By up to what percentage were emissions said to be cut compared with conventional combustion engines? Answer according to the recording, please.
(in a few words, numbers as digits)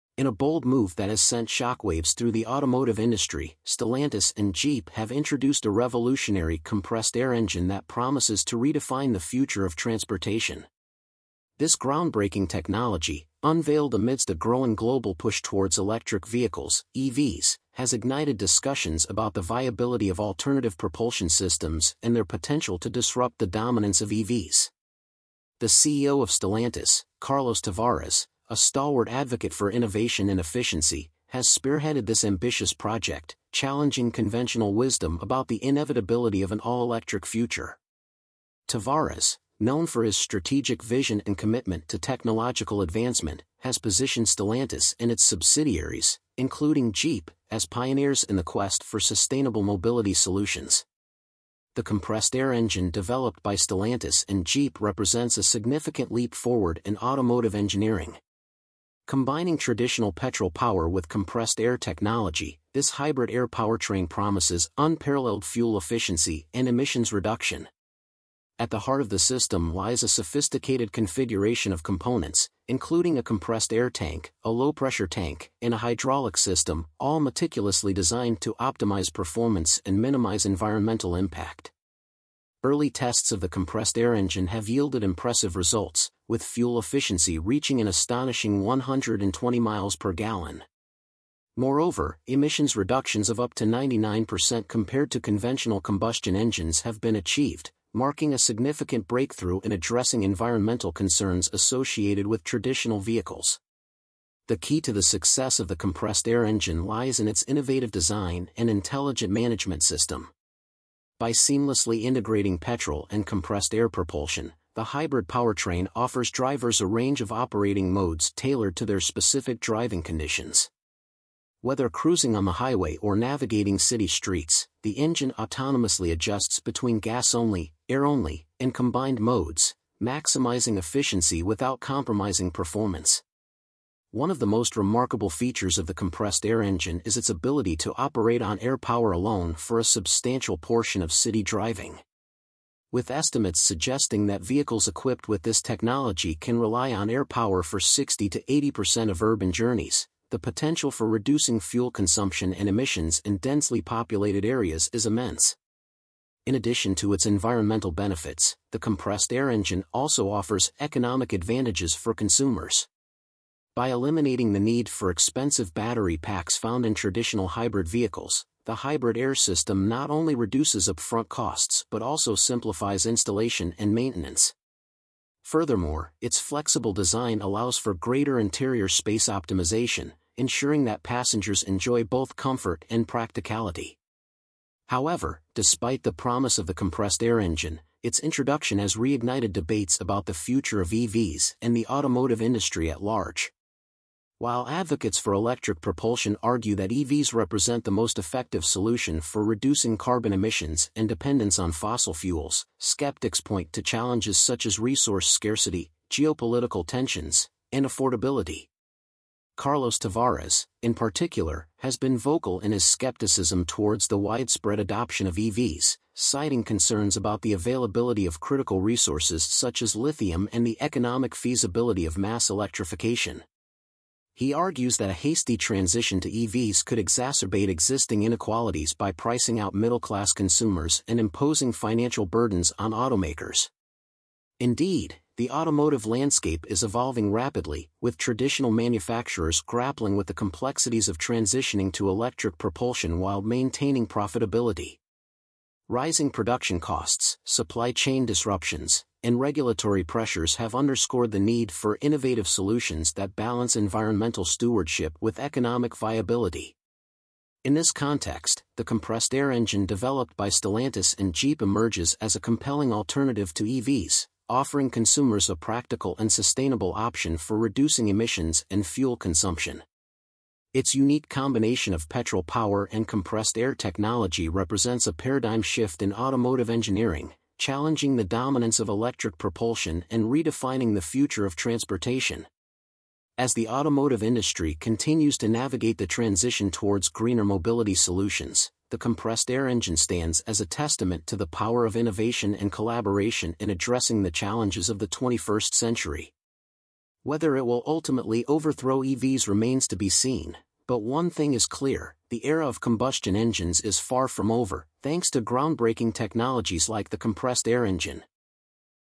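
99%.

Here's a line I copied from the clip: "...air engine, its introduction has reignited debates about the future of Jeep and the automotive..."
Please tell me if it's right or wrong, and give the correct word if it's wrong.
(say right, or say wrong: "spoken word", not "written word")
wrong: "EVs", not "Jeep".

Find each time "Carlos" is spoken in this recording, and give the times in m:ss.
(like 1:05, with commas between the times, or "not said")
0:27, 3:29.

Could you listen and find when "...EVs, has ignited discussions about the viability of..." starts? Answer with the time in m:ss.
0:16.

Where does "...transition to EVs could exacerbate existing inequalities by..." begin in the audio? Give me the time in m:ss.
3:45.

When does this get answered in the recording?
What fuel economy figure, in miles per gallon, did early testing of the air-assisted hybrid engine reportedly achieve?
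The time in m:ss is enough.
1:28.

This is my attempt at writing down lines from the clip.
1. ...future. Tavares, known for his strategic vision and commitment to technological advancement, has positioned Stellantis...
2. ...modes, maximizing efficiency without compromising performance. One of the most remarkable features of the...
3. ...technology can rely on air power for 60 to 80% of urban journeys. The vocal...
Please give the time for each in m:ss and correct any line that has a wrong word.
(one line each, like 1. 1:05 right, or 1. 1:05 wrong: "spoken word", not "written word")
1. 0:37 right
2. 2:09 right
3. 2:25 wrong: "potential", not "vocal".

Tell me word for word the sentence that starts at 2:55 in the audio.
Furthermore, its flexible design allows for greater interior space optimization, ensuring that passengers enjoy both comfort and practicality.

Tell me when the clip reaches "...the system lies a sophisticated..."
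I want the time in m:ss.
1:09.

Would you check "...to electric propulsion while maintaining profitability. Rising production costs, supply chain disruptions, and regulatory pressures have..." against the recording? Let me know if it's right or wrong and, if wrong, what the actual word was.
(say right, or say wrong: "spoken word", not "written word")
right.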